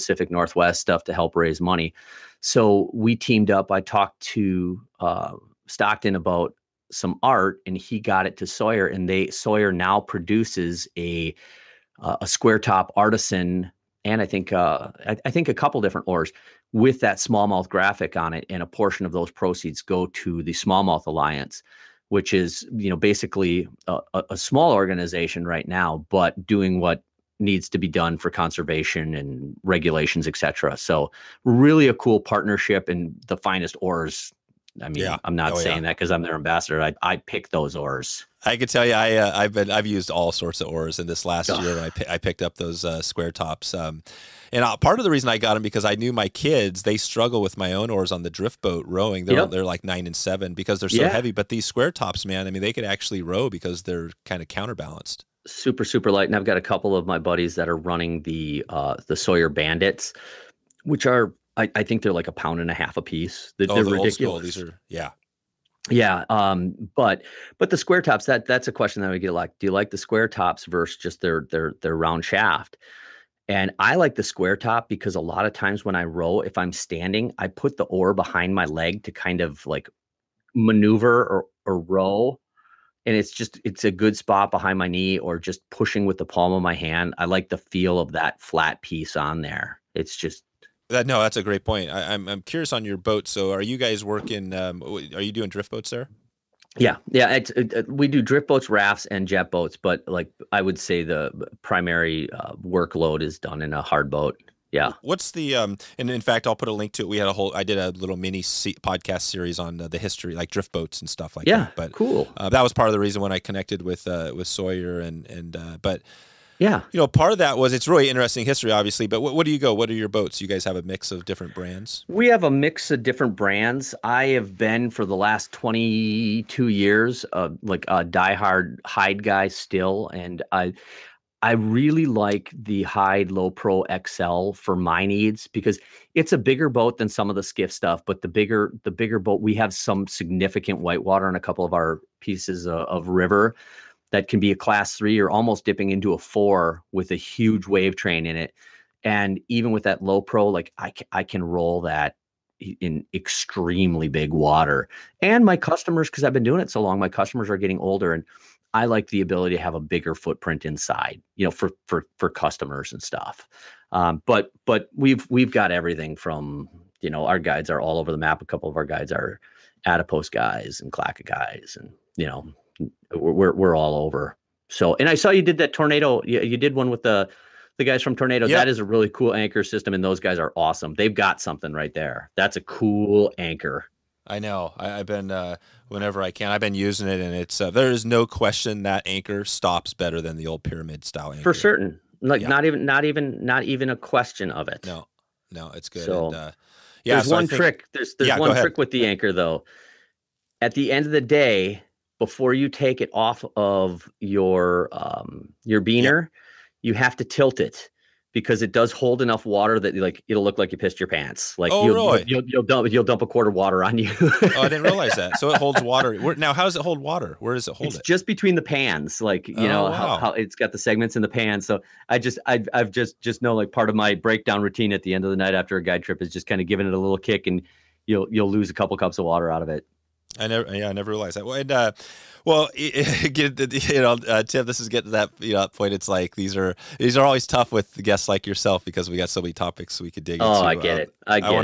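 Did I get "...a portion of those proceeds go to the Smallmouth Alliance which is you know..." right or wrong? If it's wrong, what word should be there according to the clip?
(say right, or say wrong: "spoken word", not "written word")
right.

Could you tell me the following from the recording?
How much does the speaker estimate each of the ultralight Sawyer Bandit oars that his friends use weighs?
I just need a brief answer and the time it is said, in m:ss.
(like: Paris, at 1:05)
a pound and a half, at 1:02.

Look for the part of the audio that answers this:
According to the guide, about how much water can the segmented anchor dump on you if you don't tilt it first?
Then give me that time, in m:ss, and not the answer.
3:33.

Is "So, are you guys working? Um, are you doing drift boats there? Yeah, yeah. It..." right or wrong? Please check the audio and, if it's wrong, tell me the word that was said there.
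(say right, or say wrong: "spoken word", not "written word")
right.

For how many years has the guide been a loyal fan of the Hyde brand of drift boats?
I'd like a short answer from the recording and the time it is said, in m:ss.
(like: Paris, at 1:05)
22, at 2:05.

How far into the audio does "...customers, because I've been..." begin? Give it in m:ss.
2:35.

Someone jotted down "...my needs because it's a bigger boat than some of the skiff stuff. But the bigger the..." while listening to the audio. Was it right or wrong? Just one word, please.
right.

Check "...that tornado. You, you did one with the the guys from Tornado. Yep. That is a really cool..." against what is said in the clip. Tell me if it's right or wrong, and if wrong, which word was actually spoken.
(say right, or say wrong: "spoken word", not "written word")
right.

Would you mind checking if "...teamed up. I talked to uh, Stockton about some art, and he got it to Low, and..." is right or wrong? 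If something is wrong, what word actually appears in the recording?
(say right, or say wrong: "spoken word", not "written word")
wrong: "Sawyer", not "Low".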